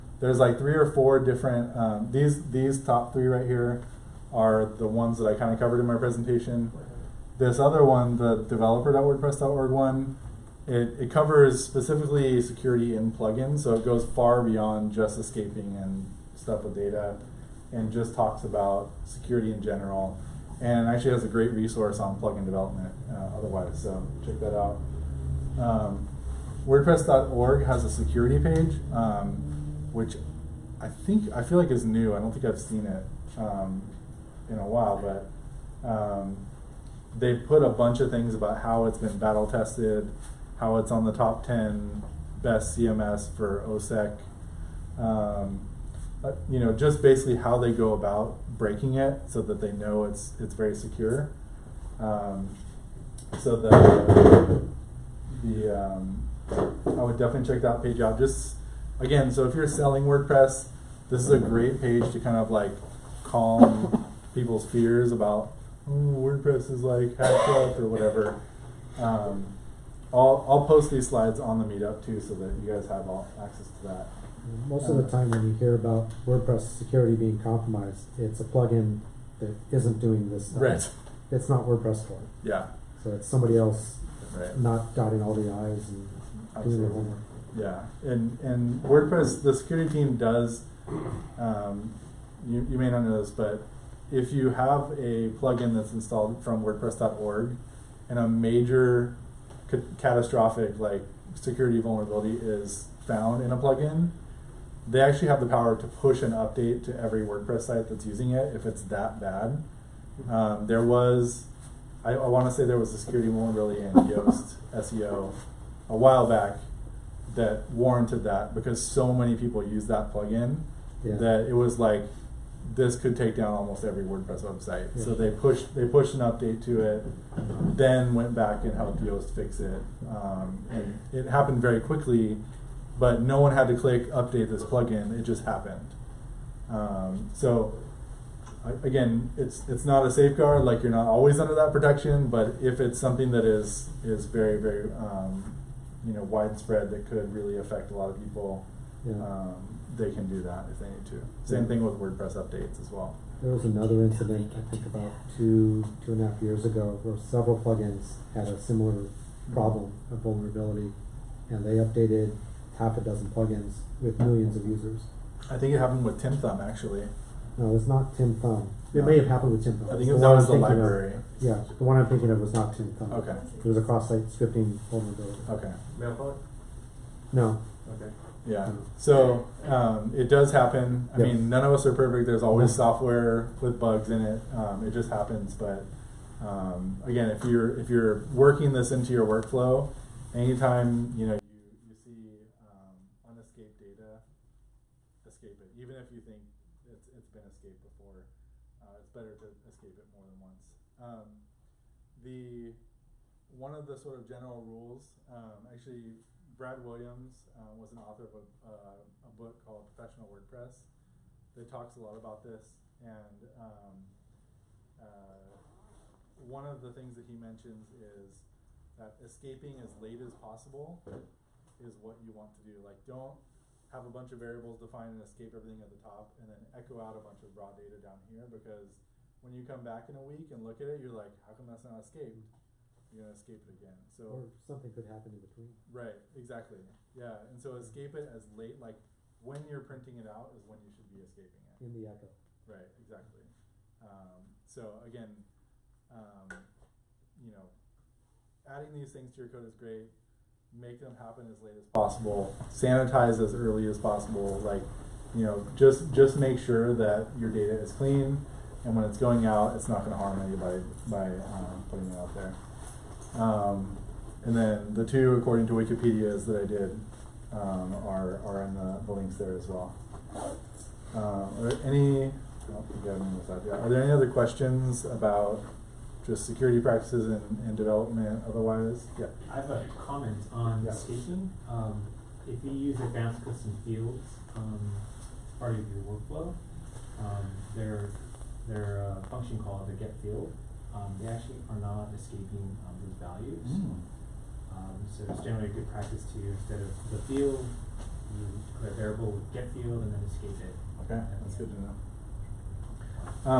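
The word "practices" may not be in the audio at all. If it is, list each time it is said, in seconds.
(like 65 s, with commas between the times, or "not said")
276 s, 295 s.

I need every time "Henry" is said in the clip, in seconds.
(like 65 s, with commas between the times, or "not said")
not said.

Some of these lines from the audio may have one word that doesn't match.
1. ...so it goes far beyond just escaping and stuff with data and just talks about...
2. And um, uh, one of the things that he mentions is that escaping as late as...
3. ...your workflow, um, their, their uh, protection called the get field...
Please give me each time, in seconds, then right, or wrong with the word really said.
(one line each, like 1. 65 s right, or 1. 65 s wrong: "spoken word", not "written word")
1. 13 s right
2. 213 s right
3. 285 s wrong: "function", not "protection".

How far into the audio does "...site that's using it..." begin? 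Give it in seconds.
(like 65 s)
107 s.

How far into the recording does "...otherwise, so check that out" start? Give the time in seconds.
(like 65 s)
23 s.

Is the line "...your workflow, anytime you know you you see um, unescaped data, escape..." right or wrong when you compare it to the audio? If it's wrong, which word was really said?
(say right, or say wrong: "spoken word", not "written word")
right.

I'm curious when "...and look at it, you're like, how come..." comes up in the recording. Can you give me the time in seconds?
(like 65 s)
230 s.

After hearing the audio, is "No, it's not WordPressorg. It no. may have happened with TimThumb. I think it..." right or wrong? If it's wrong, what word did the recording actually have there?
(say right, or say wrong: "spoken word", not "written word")
wrong: "TimThumb", not "WordPressorg".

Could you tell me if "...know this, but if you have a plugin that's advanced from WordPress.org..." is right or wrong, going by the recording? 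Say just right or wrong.
wrong.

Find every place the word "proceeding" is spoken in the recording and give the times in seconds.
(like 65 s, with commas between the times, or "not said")
not said.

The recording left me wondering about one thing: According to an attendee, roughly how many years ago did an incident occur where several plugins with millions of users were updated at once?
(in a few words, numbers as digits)
2.5.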